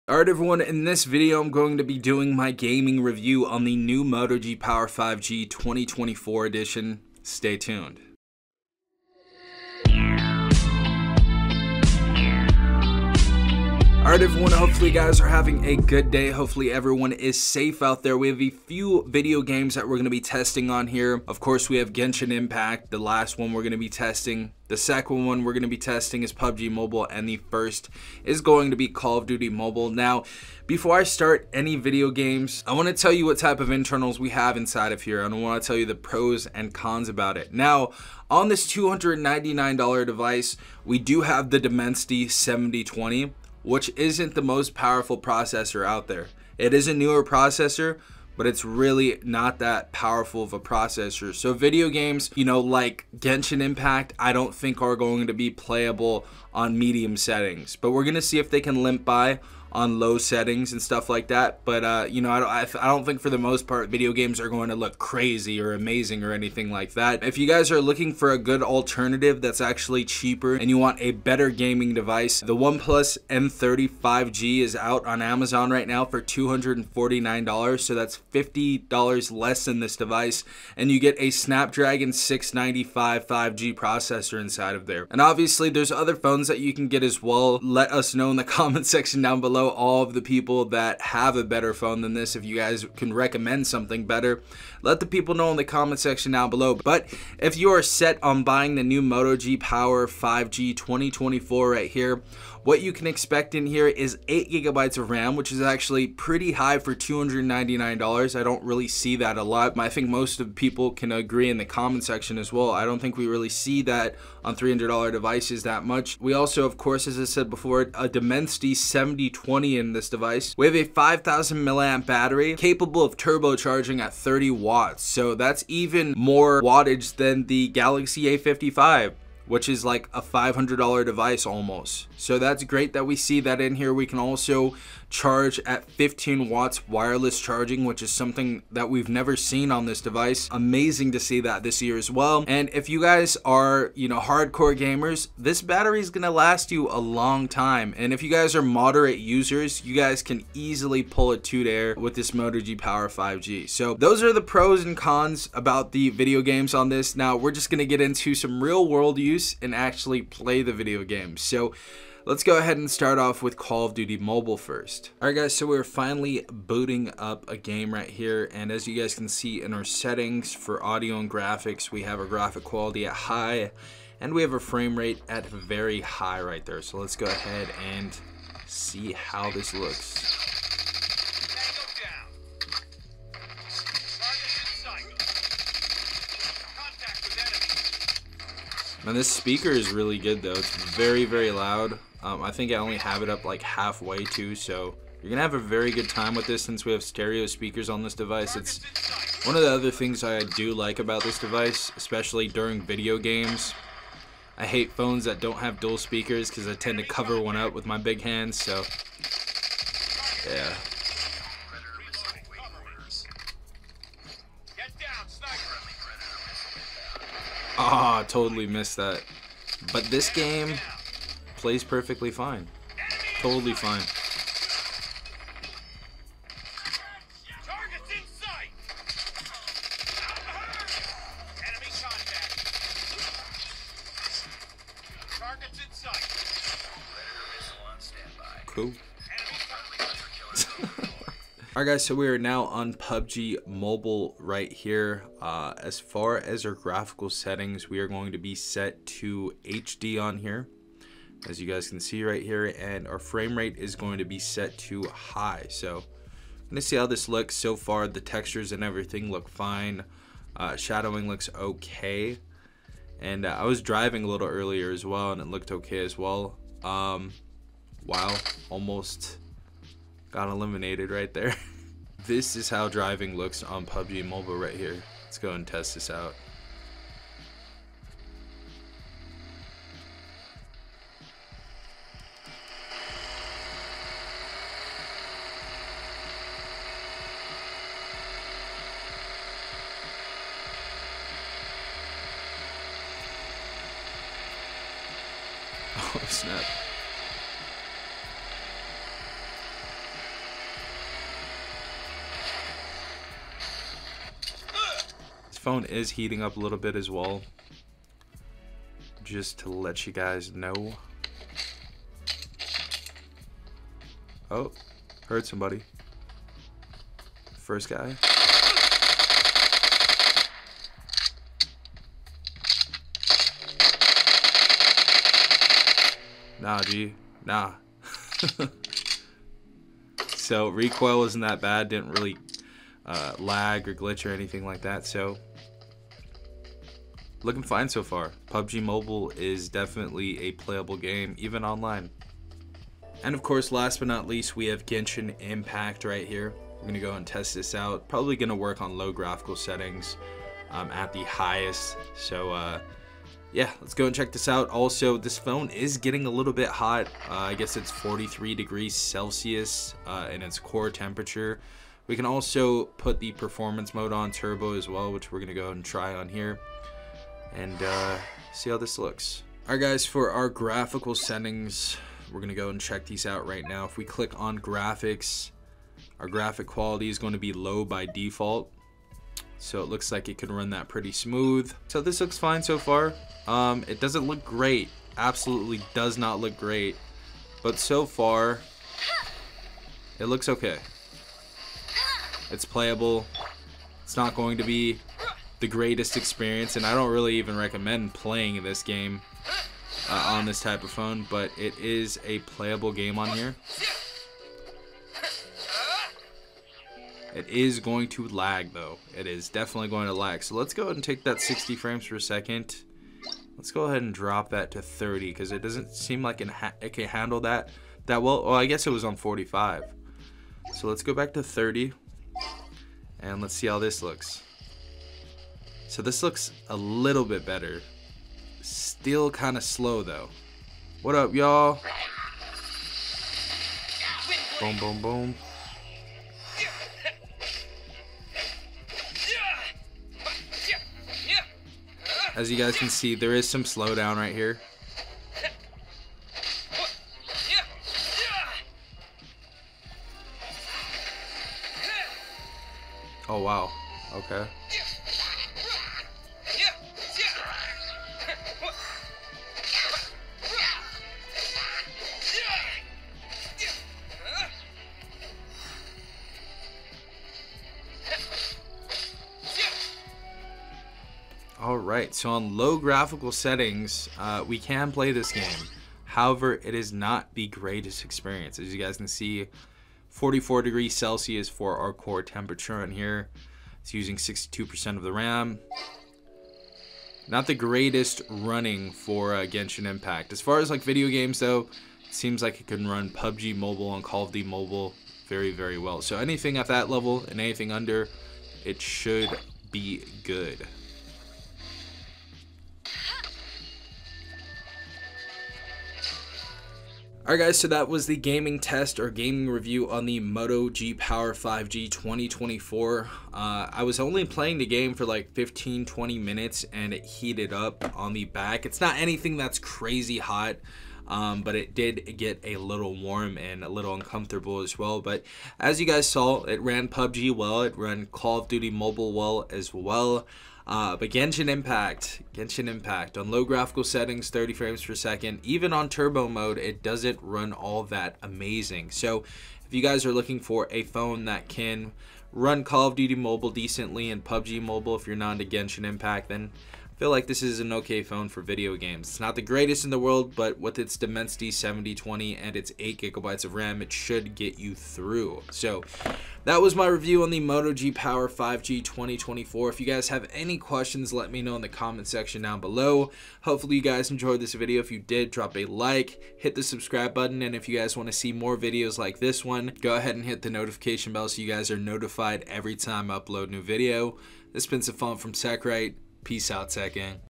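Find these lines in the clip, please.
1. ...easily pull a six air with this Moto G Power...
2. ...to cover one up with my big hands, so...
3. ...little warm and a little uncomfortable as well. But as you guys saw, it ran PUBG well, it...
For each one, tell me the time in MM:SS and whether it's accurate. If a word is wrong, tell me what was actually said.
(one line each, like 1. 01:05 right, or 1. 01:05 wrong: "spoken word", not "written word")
1. 02:30 wrong: "two", not "six"
2. 03:26 right
3. 08:42 right.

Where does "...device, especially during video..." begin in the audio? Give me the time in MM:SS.
03:21.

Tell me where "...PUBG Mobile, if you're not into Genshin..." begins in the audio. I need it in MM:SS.
09:04.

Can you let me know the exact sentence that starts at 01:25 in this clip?
And obviously there's other phones that you can get as well.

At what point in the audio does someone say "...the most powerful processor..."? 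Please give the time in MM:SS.
00:44.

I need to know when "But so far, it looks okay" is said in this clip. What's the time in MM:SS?
06:27.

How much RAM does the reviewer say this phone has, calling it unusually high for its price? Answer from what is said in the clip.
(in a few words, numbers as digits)
8 gigabytes.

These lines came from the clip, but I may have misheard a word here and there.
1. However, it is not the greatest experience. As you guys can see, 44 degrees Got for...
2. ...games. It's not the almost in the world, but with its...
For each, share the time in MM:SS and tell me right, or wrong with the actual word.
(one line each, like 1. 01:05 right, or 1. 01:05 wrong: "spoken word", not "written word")
1. 07:56 wrong: "Celsius", not "Got"
2. 09:08 wrong: "greatest", not "almost".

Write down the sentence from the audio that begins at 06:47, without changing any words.
It is going to lag though.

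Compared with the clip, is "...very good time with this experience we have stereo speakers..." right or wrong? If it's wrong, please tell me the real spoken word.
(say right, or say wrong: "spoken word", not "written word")
wrong: "since", not "experience".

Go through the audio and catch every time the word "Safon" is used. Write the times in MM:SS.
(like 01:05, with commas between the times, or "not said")
09:34.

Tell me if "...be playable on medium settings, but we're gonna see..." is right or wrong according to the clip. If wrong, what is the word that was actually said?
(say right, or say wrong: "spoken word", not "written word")
right.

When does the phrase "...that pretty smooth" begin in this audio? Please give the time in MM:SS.
06:20.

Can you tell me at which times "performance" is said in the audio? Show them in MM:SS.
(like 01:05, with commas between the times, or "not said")
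06:03.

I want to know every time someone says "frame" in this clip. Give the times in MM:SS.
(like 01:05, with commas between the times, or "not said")
02:54, 04:13, 06:51, 08:54.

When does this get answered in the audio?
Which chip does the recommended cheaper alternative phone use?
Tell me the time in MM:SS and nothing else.
01:21.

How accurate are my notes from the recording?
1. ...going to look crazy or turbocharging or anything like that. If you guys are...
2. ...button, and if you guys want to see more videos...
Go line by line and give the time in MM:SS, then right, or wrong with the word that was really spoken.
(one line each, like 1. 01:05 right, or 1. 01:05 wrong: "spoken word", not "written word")
1. 01:04 wrong: "amazing", not "turbocharging"
2. 09:27 right.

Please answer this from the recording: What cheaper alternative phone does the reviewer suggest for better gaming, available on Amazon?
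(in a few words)
OnePlus M35G.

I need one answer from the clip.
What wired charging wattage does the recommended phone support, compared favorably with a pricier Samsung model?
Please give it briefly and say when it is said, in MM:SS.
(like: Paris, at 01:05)
30 watts, at 02:04.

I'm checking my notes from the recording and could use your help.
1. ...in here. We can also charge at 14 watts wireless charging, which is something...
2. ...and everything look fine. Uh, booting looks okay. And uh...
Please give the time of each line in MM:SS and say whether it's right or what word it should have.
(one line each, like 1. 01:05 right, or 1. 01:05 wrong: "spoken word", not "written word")
1. 02:13 wrong: "15", not "14"
2. 04:18 wrong: "shadowing", not "booting".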